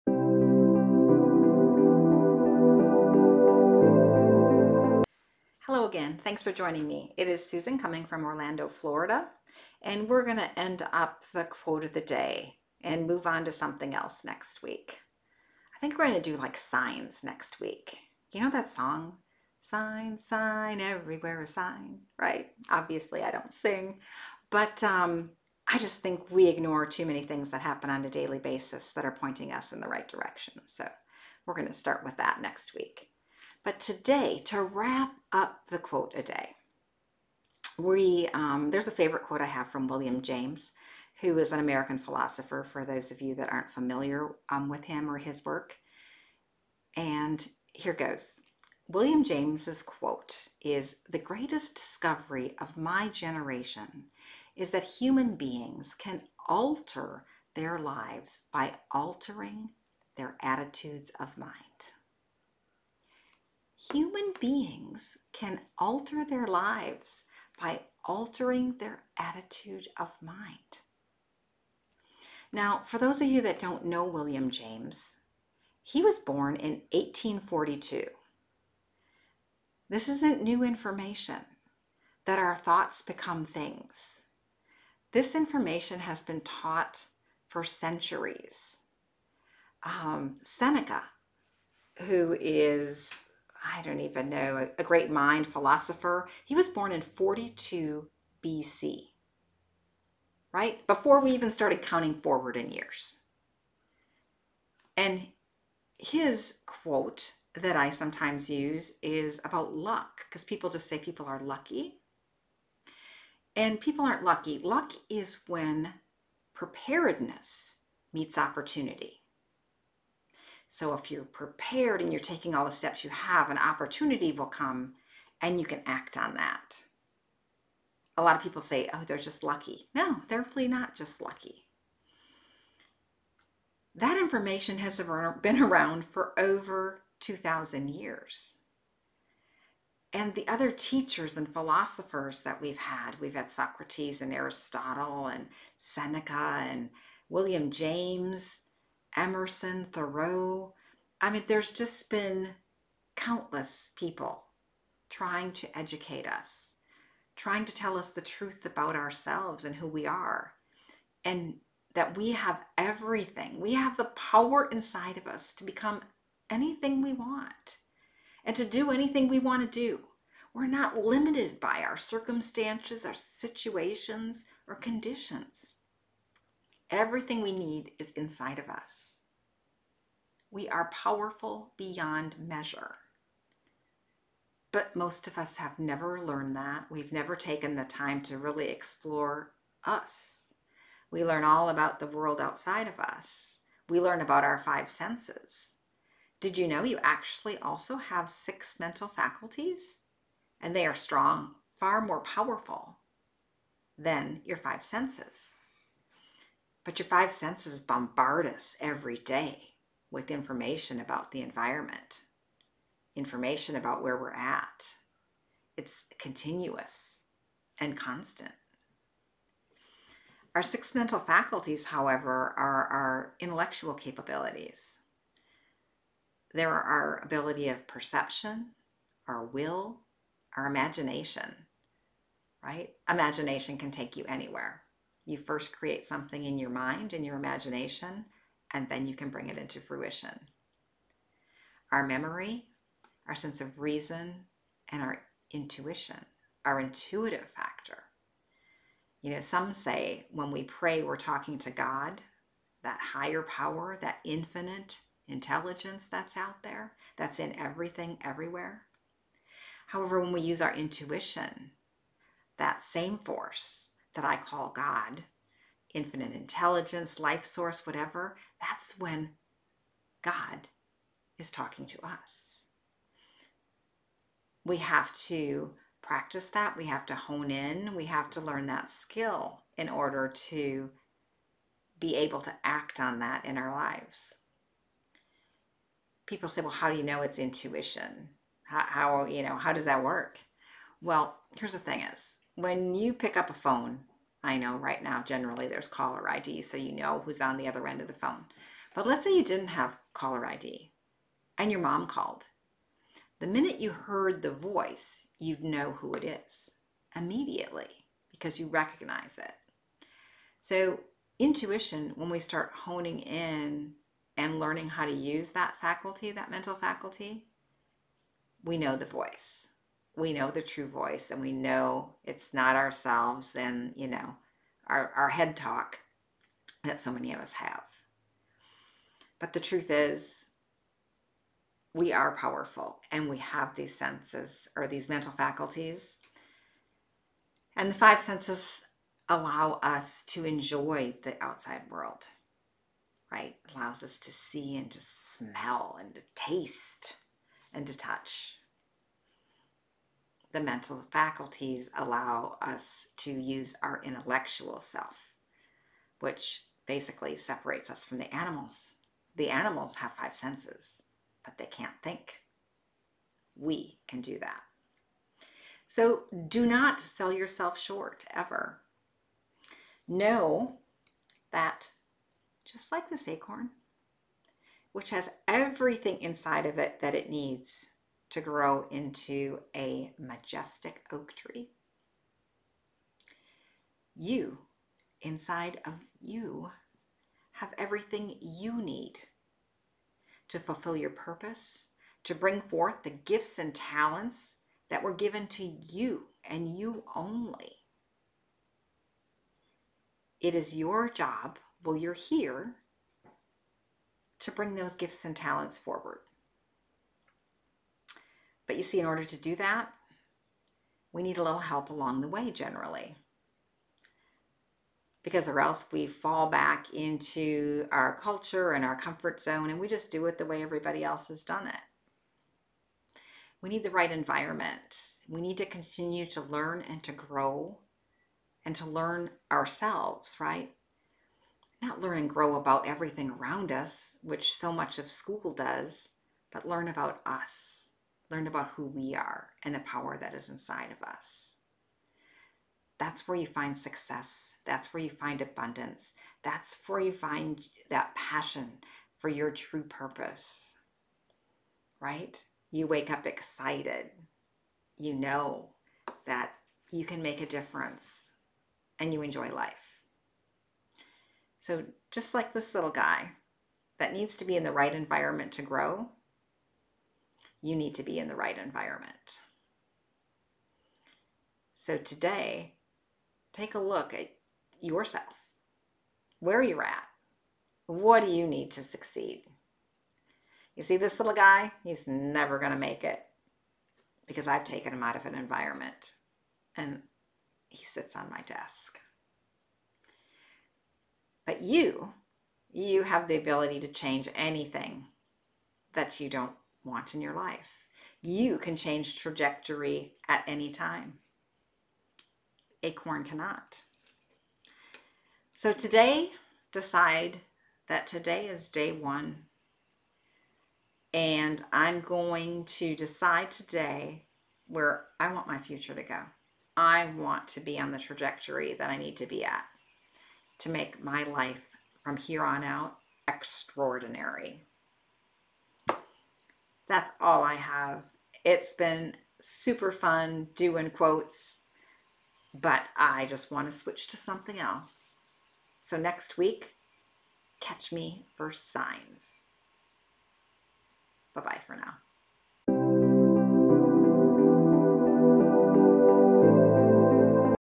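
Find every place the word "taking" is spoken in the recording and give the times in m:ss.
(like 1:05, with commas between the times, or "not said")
2:02.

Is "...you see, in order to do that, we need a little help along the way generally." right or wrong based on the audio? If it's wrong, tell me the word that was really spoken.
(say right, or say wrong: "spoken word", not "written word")
right.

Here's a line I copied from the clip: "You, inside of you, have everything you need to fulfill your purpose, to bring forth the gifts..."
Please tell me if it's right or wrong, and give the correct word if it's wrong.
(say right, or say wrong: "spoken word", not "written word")
right.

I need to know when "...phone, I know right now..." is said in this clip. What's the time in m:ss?
4:53.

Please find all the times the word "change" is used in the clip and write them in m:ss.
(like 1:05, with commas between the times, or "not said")
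8:13, 8:18.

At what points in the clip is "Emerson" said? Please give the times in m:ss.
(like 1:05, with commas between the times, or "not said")
2:29.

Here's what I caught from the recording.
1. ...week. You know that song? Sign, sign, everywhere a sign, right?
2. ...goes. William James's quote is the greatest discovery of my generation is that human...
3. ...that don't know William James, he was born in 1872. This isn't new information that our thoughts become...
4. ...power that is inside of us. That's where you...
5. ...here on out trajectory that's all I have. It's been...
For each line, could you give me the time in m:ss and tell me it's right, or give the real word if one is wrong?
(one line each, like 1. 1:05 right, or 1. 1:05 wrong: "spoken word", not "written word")
1. 0:17 right
2. 0:47 right
3. 1:13 wrong: "1842", not "1872"
4. 7:19 right
5. 8:42 wrong: "extraordinary", not "trajectory".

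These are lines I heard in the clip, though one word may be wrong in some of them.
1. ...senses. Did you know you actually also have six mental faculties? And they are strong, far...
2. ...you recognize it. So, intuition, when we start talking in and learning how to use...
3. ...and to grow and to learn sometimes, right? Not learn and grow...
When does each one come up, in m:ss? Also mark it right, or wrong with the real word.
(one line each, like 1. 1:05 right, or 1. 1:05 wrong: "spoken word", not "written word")
1. 3:14 right
2. 5:08 wrong: "honing", not "talking"
3. 7:06 wrong: "ourselves", not "sometimes".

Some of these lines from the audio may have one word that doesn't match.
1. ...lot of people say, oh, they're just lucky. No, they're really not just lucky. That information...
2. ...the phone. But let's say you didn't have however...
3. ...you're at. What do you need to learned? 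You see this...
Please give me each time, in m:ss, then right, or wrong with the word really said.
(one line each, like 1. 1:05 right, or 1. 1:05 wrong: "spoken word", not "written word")
1. 2:08 right
2. 4:58 wrong: "caller", not "however"
3. 7:56 wrong: "succeed", not "learned".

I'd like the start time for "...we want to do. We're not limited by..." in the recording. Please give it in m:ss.
2:49.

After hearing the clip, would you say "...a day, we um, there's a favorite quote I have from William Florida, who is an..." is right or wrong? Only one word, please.
wrong.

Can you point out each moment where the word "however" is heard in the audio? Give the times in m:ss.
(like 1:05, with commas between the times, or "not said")
3:41, 4:19.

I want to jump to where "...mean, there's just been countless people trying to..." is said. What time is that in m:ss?
2:31.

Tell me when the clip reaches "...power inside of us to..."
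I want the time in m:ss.
2:44.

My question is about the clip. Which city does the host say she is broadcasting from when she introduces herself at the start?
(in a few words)
Orlando, Florida.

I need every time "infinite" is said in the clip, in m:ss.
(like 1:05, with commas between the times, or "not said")
4:14, 4:25.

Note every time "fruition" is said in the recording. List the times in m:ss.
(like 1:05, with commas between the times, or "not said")
3:59.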